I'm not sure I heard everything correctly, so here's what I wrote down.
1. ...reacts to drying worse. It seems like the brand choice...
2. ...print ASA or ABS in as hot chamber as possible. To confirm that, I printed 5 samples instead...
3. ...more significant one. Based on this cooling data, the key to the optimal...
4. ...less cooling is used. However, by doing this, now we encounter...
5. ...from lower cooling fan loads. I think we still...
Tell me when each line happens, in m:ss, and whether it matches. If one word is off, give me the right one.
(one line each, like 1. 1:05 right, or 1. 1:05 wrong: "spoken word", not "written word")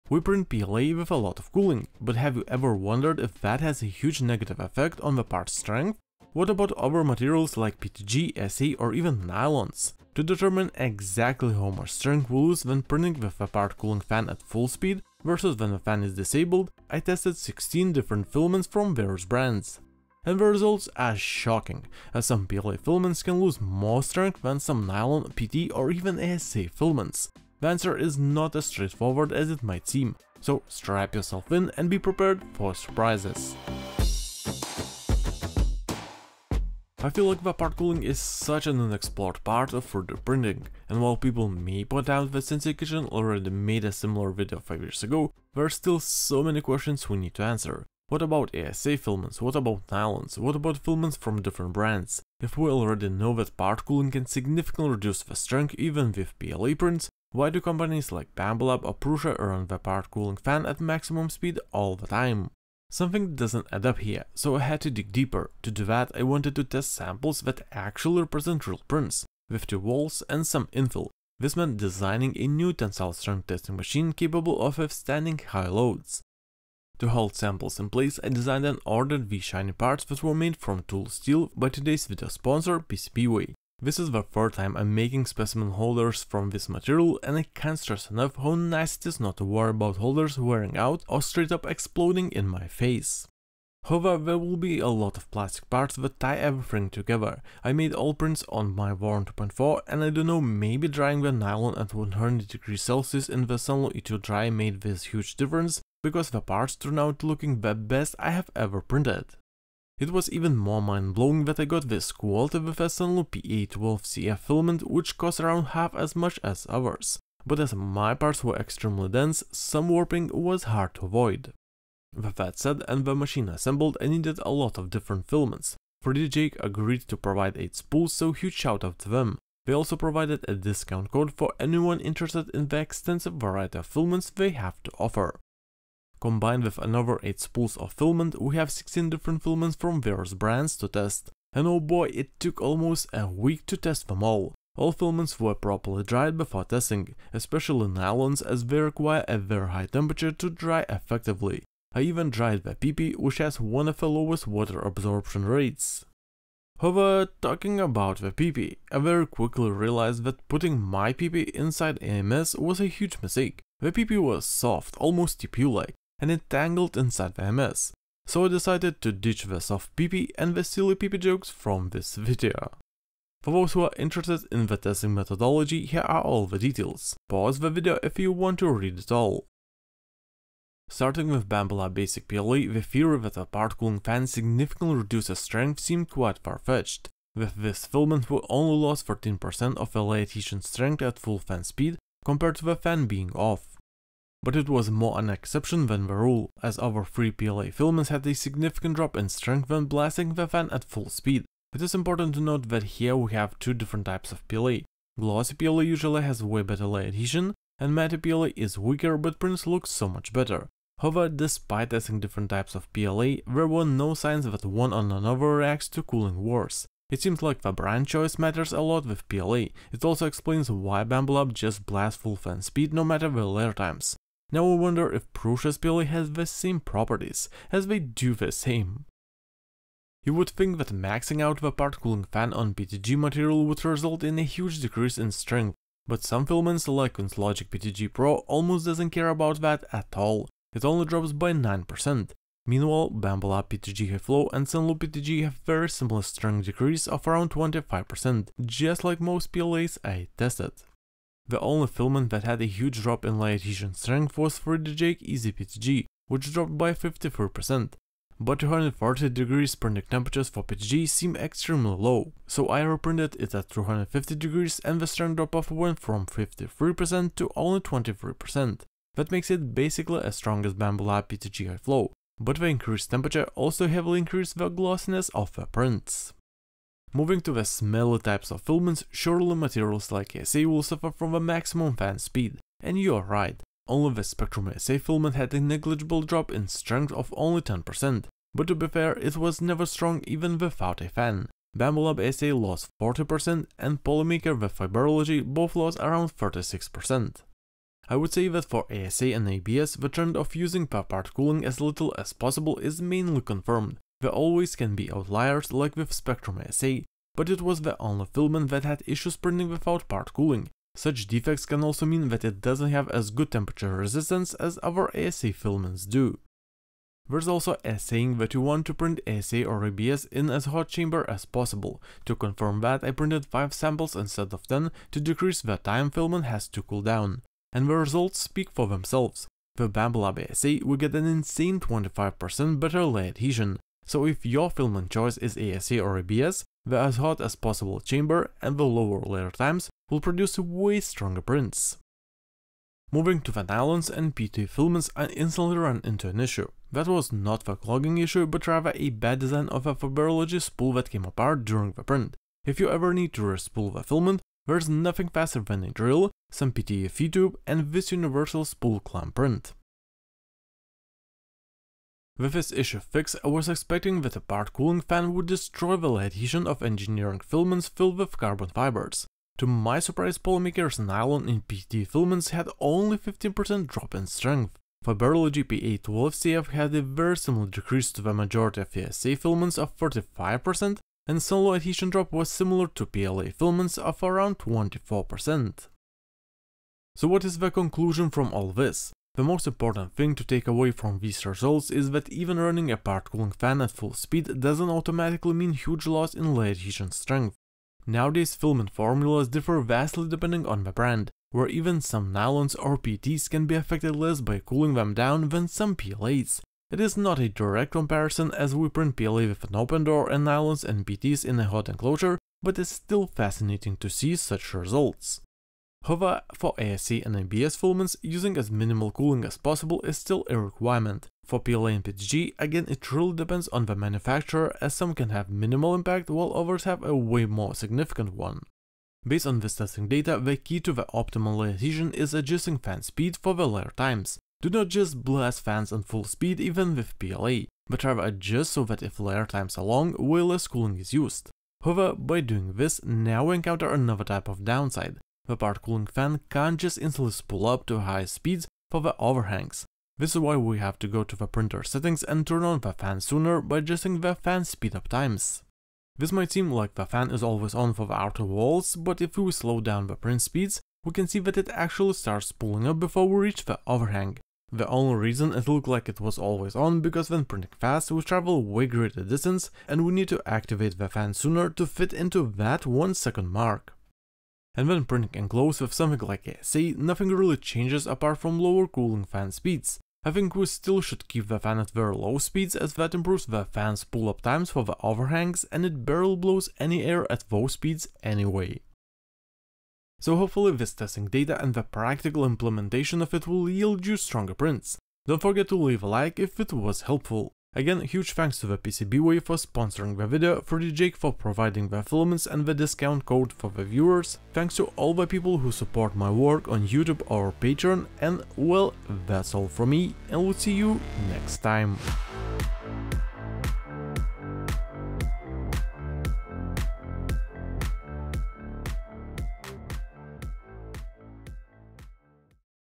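1. 3:35 wrong: "cooling", not "drying"
2. 5:18 right
3. 7:07 wrong: "testing", not "cooling"
4. 7:20 right
5. 7:58 wrong: "speeds", not "loads".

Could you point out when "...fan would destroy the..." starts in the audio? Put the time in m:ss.
6:05.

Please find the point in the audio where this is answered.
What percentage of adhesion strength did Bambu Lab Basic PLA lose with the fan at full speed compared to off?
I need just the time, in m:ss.
3:09.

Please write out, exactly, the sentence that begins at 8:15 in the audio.
Don't forget to leave a like if it was helpful.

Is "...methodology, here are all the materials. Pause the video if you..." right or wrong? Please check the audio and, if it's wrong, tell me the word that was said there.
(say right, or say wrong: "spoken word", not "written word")
wrong: "details", not "materials".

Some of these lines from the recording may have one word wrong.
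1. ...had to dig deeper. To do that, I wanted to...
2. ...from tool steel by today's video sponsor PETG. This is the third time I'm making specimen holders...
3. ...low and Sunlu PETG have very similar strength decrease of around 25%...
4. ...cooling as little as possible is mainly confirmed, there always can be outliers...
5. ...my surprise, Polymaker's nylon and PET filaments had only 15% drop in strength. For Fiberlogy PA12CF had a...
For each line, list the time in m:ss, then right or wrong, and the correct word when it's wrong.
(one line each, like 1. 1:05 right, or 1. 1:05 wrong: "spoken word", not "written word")
1. 1:04 right
2. 1:20 wrong: "PCBWay", not "PETG"
3. 4:04 right
4. 5:01 right
5. 6:09 right.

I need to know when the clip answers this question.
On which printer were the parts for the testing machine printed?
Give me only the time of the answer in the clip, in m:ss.
1:38.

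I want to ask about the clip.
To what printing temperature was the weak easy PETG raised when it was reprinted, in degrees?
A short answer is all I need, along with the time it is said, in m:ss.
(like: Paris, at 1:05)
250, at 4:23.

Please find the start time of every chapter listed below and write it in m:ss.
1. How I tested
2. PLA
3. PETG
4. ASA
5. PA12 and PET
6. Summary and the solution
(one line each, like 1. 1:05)
1. 1:04
2. 3:00
3. 3:49
4. 4:36
5. 5:42
6. 6:27.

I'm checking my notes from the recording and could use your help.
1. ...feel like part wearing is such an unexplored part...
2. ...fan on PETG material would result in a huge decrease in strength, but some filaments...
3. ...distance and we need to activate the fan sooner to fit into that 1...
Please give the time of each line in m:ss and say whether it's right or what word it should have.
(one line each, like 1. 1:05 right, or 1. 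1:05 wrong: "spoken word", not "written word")
1. 0:37 wrong: "cooling", not "wearing"
2. 3:52 right
3. 7:49 right.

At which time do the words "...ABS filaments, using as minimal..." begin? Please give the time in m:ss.
6:57.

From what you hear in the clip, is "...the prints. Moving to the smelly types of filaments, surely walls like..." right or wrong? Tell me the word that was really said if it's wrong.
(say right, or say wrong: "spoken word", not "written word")
wrong: "materials", not "walls".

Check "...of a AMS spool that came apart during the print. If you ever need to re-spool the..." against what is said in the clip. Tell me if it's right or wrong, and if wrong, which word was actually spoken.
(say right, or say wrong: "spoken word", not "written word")
wrong: "Fiberlogy", not "AMS".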